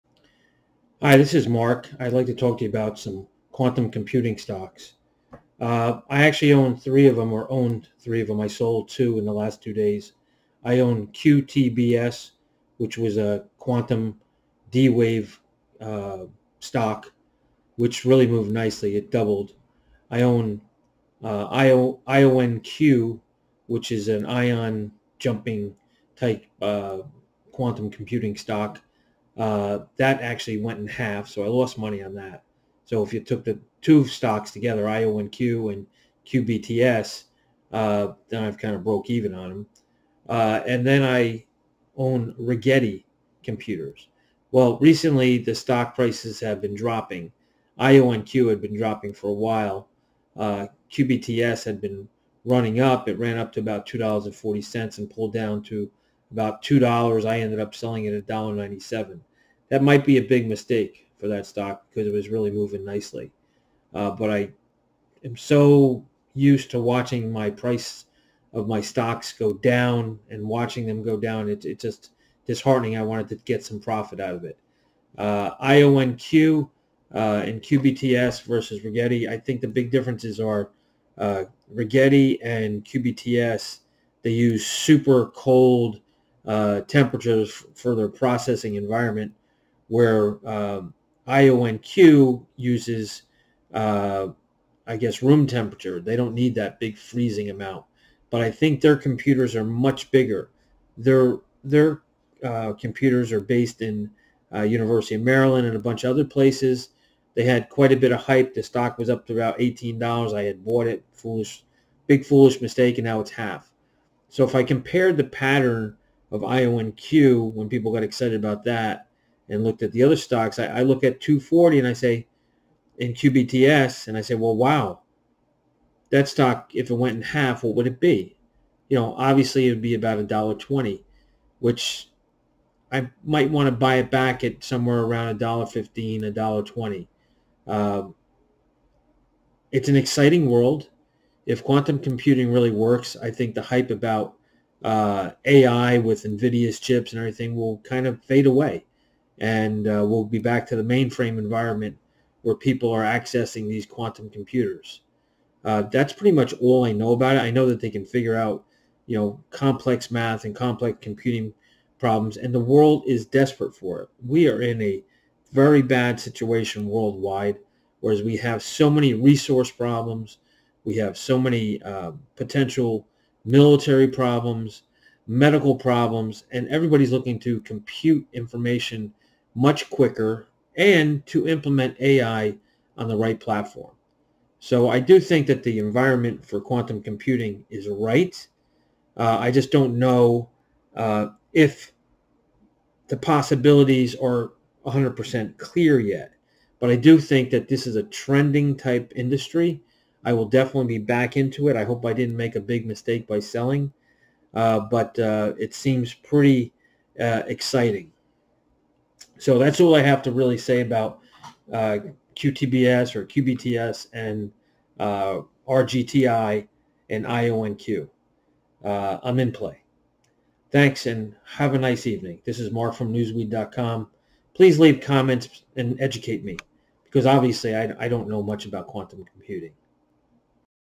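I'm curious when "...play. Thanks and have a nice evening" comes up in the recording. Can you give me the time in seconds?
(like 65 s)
219 s.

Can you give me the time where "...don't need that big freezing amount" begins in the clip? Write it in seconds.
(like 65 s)
96 s.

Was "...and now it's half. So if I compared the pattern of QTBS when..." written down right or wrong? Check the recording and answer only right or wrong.
wrong.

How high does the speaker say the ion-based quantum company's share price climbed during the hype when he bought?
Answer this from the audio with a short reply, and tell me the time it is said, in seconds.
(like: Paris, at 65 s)
$18, at 109 s.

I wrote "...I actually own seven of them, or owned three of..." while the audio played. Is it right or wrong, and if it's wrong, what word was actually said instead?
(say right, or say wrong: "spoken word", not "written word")
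wrong: "three", not "seven".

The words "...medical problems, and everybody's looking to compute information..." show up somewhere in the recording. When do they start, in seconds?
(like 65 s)
175 s.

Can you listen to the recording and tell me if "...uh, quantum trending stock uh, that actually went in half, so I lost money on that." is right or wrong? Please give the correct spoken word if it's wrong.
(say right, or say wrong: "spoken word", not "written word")
wrong: "computing", not "trending".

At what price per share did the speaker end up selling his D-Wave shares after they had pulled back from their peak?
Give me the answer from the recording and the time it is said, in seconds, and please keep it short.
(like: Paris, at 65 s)
$1.97, at 58 s.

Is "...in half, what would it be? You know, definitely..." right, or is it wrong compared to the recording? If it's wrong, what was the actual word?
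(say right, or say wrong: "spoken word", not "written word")
wrong: "obviously", not "definitely".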